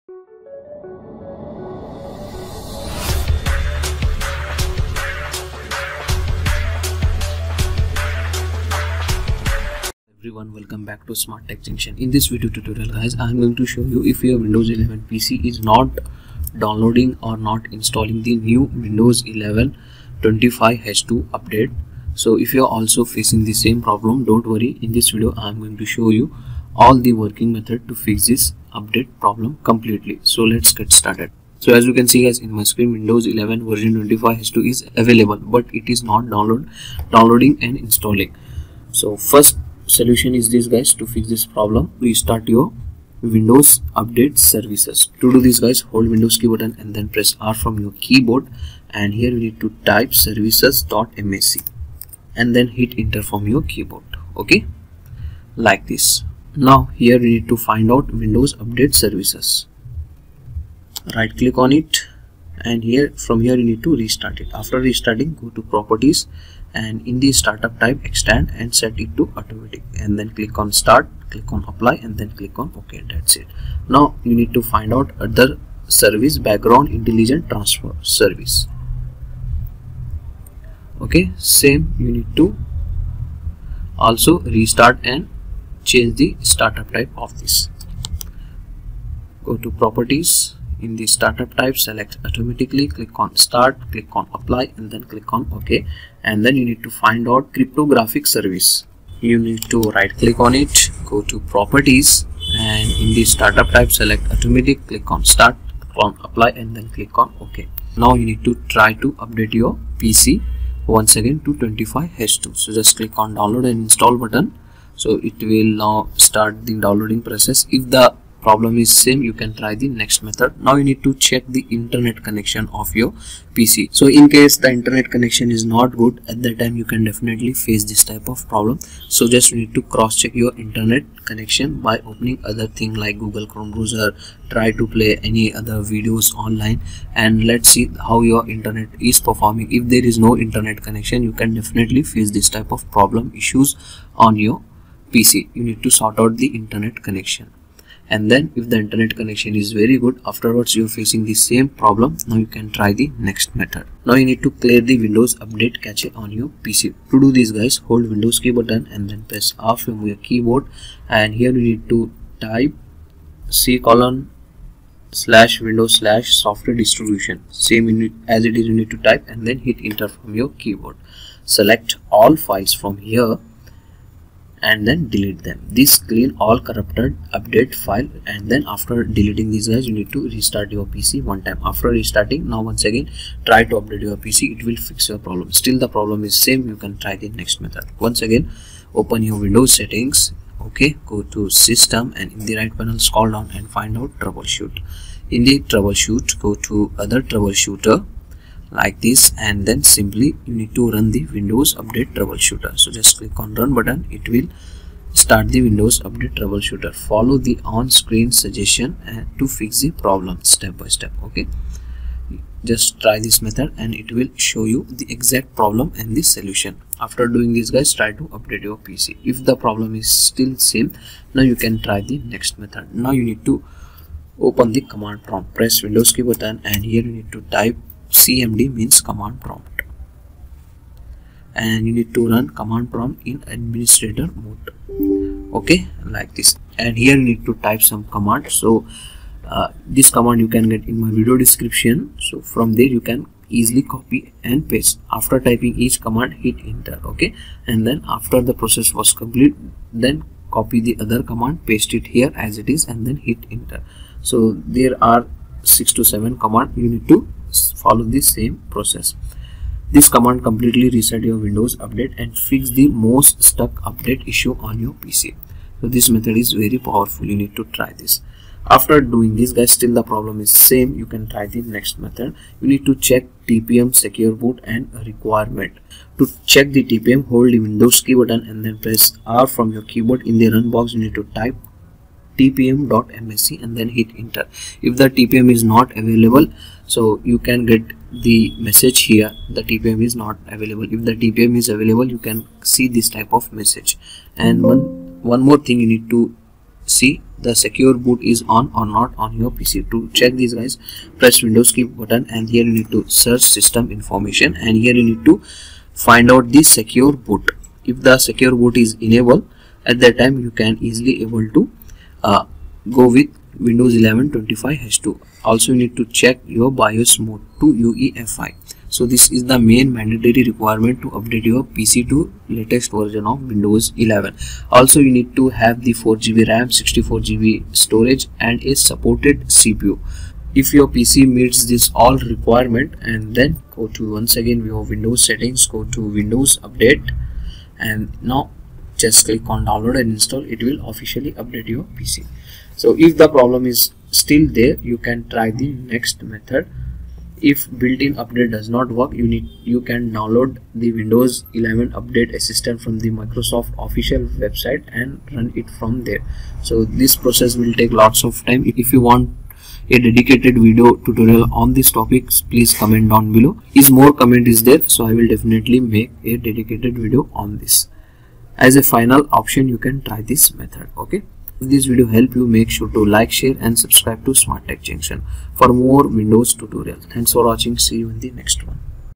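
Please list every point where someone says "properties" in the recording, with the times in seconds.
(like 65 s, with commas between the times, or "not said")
65 s, 89 s, 101 s.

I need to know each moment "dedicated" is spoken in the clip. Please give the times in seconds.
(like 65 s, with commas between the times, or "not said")
360 s, 366 s.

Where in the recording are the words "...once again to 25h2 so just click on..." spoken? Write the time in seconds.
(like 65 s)
110 s.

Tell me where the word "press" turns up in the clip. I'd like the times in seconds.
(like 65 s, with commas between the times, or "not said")
47 s, 159 s, 225 s, 278 s, 301 s.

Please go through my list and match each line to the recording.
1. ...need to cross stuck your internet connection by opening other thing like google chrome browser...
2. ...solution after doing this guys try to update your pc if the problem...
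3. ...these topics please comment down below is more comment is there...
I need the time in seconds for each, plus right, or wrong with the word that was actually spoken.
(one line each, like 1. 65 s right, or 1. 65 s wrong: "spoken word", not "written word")
1. 129 s wrong: "check", not "stuck"
2. 216 s right
3. 361 s right.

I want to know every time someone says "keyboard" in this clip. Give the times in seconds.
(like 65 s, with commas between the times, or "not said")
48 s, 53 s, 160 s, 170 s, 279 s.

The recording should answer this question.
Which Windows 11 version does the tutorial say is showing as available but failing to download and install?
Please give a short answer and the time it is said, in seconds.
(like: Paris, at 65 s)
25H2, at 32 s.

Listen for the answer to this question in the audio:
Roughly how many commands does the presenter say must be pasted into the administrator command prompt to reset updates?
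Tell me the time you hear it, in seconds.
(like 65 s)
255 s.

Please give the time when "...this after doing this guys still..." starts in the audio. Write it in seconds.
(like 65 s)
268 s.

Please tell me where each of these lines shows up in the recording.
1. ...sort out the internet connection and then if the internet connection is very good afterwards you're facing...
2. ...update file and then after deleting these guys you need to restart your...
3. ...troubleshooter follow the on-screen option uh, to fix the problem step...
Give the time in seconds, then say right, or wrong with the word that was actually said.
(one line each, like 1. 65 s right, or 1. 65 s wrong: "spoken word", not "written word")
1. 146 s right
2. 177 s right
3. 206 s wrong: "suggestion", not "option".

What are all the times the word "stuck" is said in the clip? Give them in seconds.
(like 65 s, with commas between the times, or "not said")
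263 s.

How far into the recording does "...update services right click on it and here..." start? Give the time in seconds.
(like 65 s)
58 s.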